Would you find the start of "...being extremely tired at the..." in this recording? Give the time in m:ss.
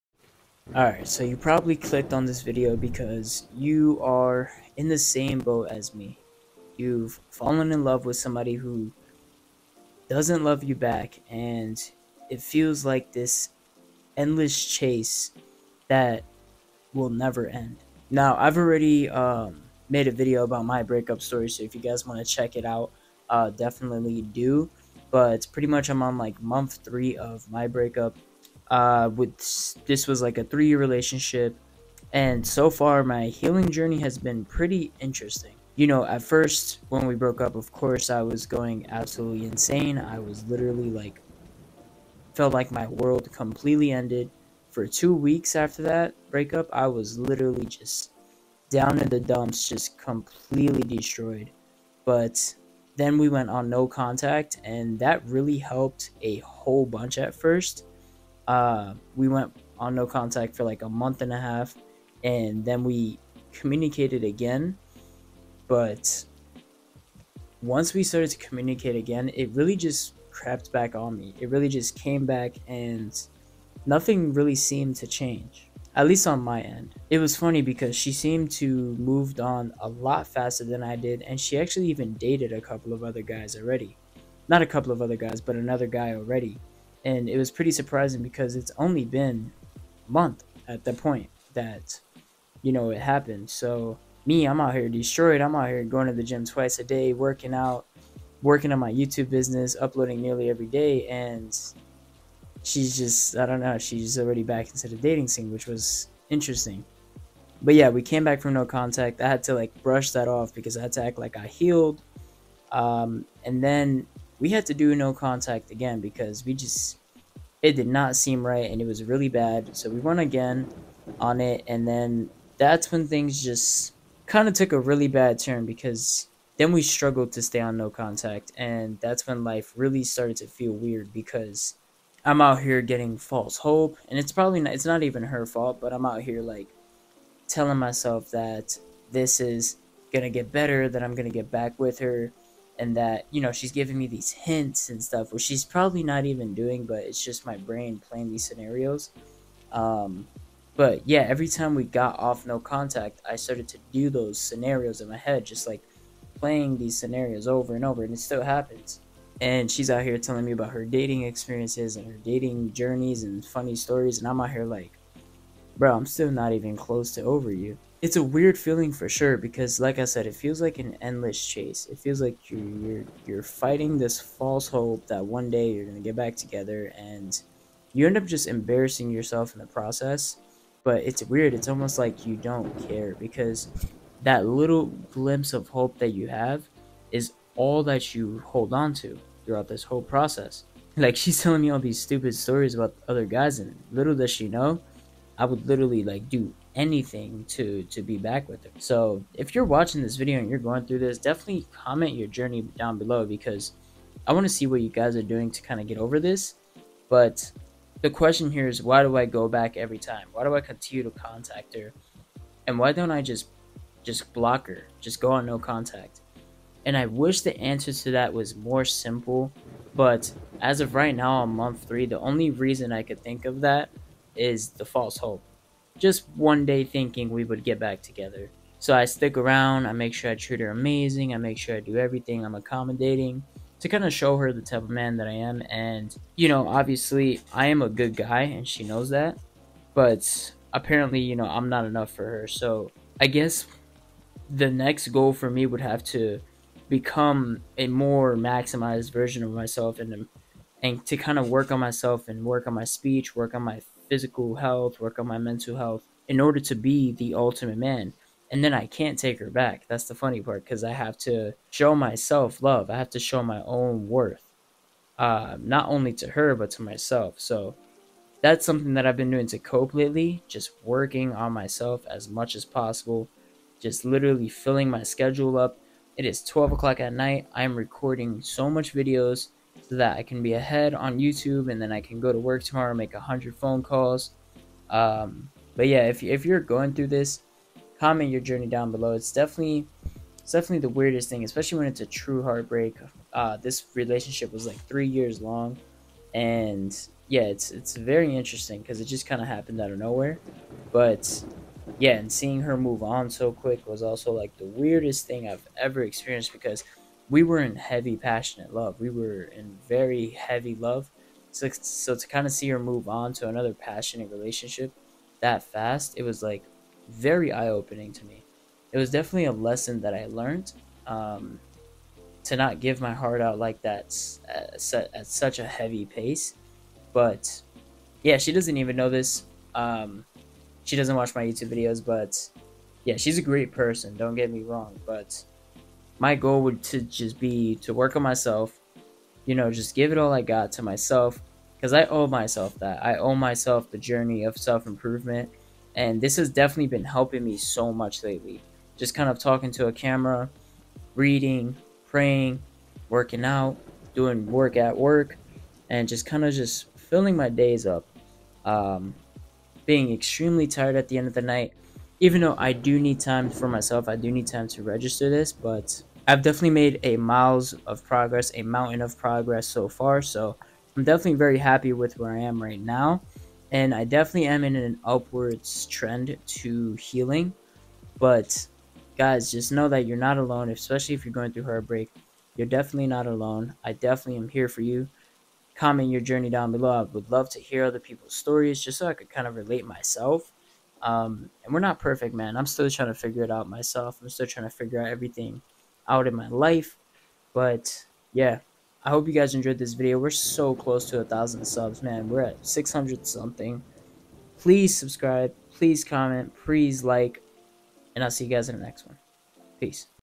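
5:59.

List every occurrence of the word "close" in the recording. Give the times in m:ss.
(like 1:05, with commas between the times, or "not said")
2:46, 6:40.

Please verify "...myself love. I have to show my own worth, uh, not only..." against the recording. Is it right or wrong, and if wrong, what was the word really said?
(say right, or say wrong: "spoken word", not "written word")
right.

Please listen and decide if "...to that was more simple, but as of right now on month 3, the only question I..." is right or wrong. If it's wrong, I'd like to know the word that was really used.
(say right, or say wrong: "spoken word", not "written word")
wrong: "reason", not "question".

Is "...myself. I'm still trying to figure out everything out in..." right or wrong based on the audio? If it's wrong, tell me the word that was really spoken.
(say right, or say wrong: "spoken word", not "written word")
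right.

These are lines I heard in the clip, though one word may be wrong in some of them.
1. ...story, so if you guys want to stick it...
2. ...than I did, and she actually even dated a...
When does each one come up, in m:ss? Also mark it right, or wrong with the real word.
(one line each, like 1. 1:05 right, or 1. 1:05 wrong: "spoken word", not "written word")
1. 0:21 wrong: "check", not "stick"
2. 1:20 right.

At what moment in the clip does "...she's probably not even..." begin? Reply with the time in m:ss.
2:25.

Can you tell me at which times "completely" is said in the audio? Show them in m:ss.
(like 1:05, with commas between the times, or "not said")
0:43, 0:49.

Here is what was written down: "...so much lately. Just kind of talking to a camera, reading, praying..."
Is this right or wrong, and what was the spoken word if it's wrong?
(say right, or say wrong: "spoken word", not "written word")
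right.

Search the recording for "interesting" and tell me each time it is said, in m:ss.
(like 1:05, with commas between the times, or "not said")
0:35, 1:46, 4:58.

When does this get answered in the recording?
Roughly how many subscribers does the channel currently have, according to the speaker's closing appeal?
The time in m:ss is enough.
6:42.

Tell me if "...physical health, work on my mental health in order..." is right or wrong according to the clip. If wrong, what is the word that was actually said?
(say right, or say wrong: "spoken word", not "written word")
right.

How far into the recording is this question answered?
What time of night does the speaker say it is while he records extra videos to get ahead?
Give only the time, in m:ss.
4:36.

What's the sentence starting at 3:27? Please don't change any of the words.
But the question here is why do I go back every time?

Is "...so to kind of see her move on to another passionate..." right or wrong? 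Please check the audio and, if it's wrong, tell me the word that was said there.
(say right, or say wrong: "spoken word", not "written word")
right.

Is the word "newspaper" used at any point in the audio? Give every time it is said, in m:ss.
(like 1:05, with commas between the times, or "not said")
not said.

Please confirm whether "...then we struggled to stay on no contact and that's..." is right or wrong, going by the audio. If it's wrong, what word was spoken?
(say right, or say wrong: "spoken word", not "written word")
right.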